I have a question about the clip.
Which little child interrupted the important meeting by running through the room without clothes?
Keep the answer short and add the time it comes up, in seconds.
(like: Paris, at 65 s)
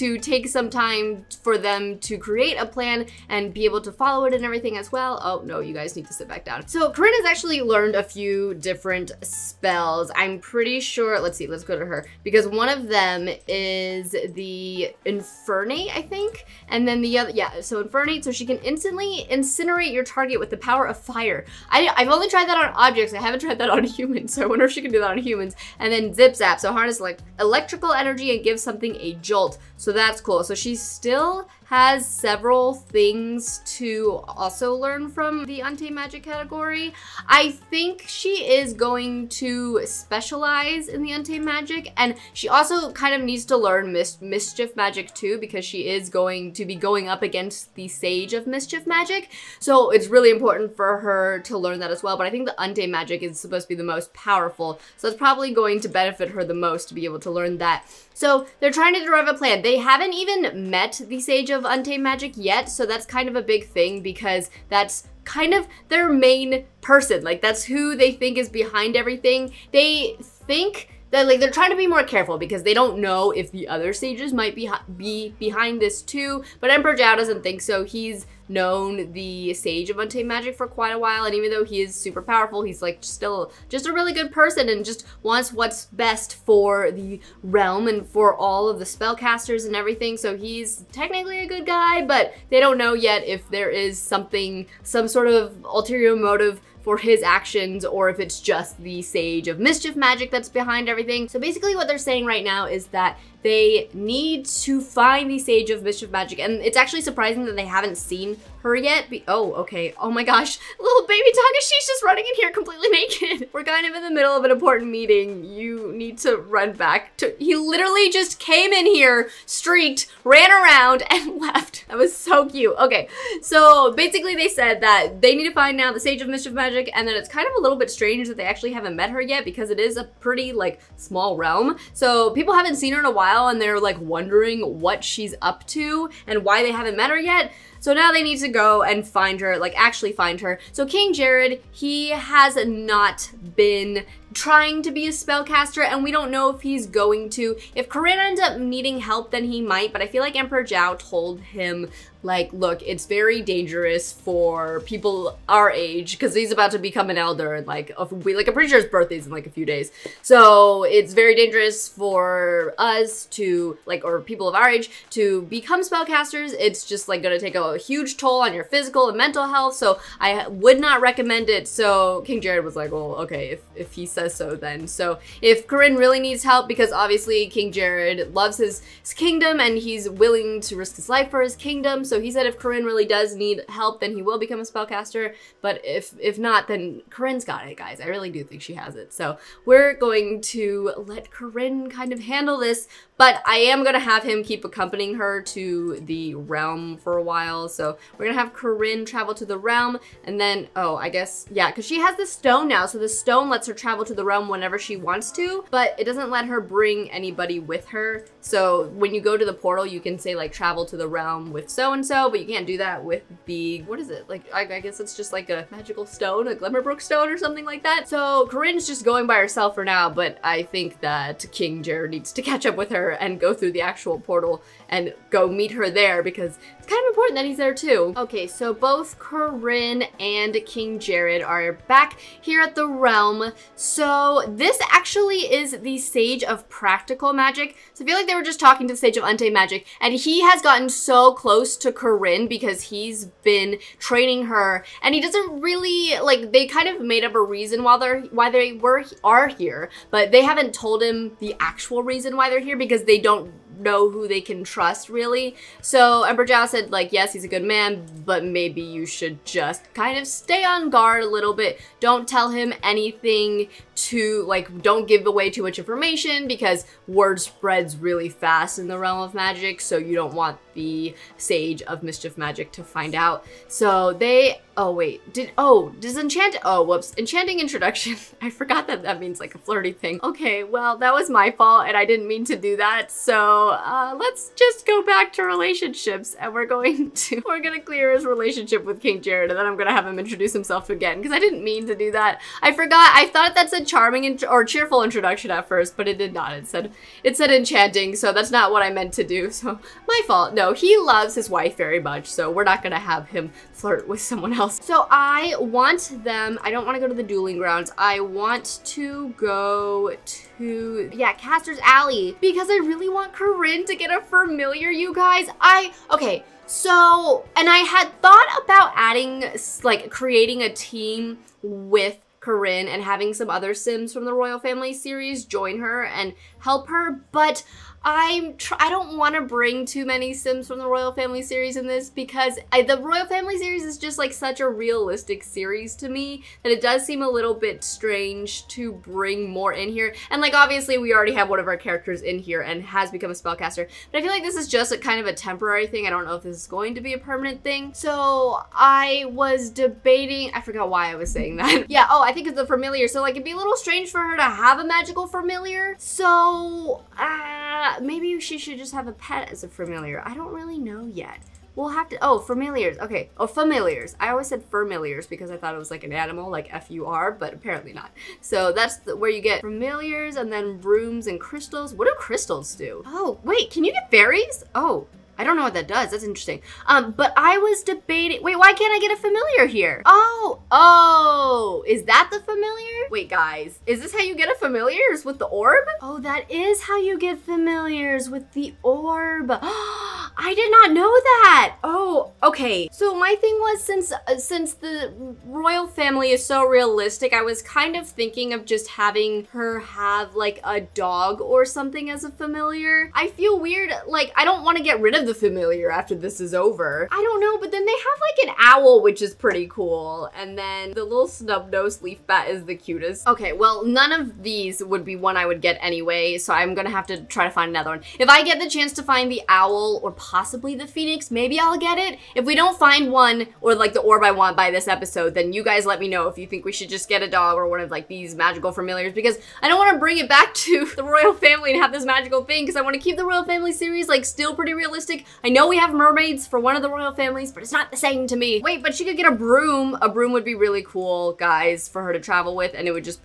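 Takashi, at 111 s.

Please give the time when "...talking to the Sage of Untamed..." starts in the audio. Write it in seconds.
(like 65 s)
238 s.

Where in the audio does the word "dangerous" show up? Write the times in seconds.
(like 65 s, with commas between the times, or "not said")
153 s, 161 s.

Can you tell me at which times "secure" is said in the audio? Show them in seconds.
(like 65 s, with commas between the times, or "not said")
not said.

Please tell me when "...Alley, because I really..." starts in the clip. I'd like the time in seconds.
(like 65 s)
311 s.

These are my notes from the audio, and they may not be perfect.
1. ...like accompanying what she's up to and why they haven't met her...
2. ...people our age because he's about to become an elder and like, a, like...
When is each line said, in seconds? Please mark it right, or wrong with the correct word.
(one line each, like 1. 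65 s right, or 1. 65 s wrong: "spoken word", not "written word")
1. 133 s wrong: "wondering", not "accompanying"
2. 154 s right.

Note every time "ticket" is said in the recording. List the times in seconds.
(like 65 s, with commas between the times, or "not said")
not said.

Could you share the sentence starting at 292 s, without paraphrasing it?
I forgot, I thought that's a charming or cheerful introduction at first, but it did not.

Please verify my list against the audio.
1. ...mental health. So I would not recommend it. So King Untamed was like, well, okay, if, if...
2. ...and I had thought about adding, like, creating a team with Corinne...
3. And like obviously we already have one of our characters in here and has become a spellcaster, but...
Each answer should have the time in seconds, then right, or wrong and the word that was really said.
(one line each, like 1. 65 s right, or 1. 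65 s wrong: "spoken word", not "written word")
1. 169 s wrong: "Jared", not "Untamed"
2. 317 s right
3. 340 s right.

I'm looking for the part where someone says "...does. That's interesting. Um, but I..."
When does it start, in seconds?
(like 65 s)
375 s.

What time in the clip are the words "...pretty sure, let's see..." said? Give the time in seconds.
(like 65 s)
10 s.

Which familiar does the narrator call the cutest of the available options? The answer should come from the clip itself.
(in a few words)
snub-nosed leaf bat.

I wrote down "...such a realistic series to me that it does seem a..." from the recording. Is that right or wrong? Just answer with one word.
right.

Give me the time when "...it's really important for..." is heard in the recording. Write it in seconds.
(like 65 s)
49 s.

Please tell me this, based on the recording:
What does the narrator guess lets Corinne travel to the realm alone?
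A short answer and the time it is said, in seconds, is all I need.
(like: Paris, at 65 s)
Glimmerbrook stone, at 216 s.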